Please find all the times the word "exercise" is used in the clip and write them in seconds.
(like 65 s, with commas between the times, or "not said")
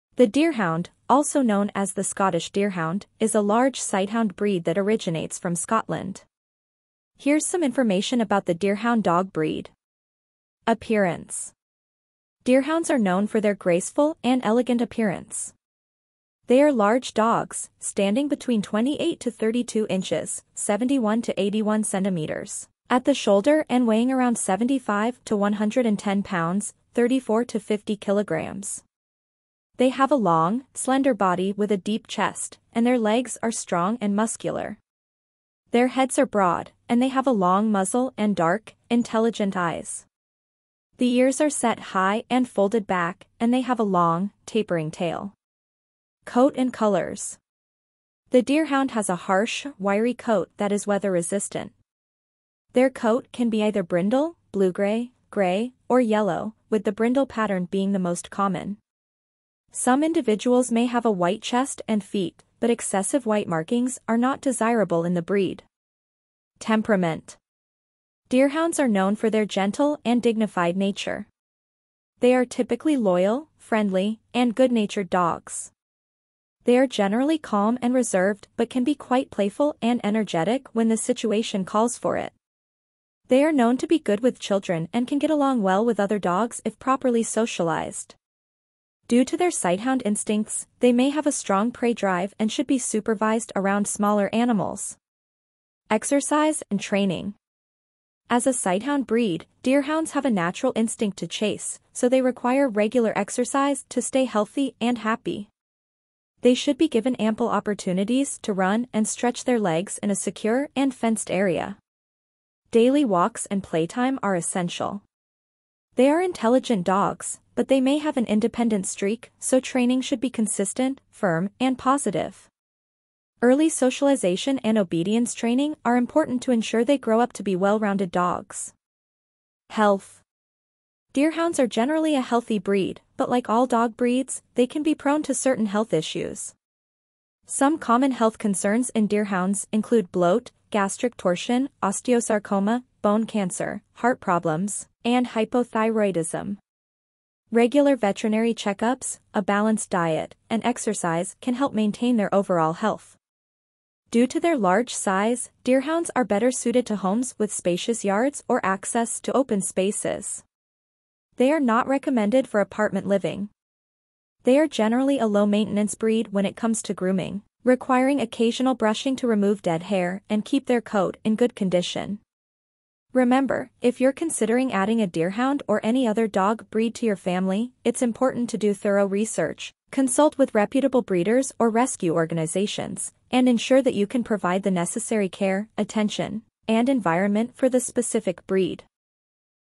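95 s, 103 s, 150 s.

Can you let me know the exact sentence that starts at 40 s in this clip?
The ears are set high and folded back, and they have a long, tapering tail.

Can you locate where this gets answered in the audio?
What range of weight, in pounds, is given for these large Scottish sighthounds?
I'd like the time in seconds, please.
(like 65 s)
24 s.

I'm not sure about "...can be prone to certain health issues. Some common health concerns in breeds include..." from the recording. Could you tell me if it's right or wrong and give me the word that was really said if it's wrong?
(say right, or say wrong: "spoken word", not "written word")
wrong: "deerhounds", not "breeds".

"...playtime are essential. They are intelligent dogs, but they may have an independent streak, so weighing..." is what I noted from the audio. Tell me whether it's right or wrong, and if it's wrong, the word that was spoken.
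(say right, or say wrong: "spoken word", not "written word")
wrong: "training", not "weighing".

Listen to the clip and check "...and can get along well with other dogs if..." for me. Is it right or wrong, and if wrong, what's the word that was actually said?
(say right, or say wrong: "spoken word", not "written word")
right.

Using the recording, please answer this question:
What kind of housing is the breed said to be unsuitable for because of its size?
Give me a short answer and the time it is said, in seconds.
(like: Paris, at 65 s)
apartment living, at 162 s.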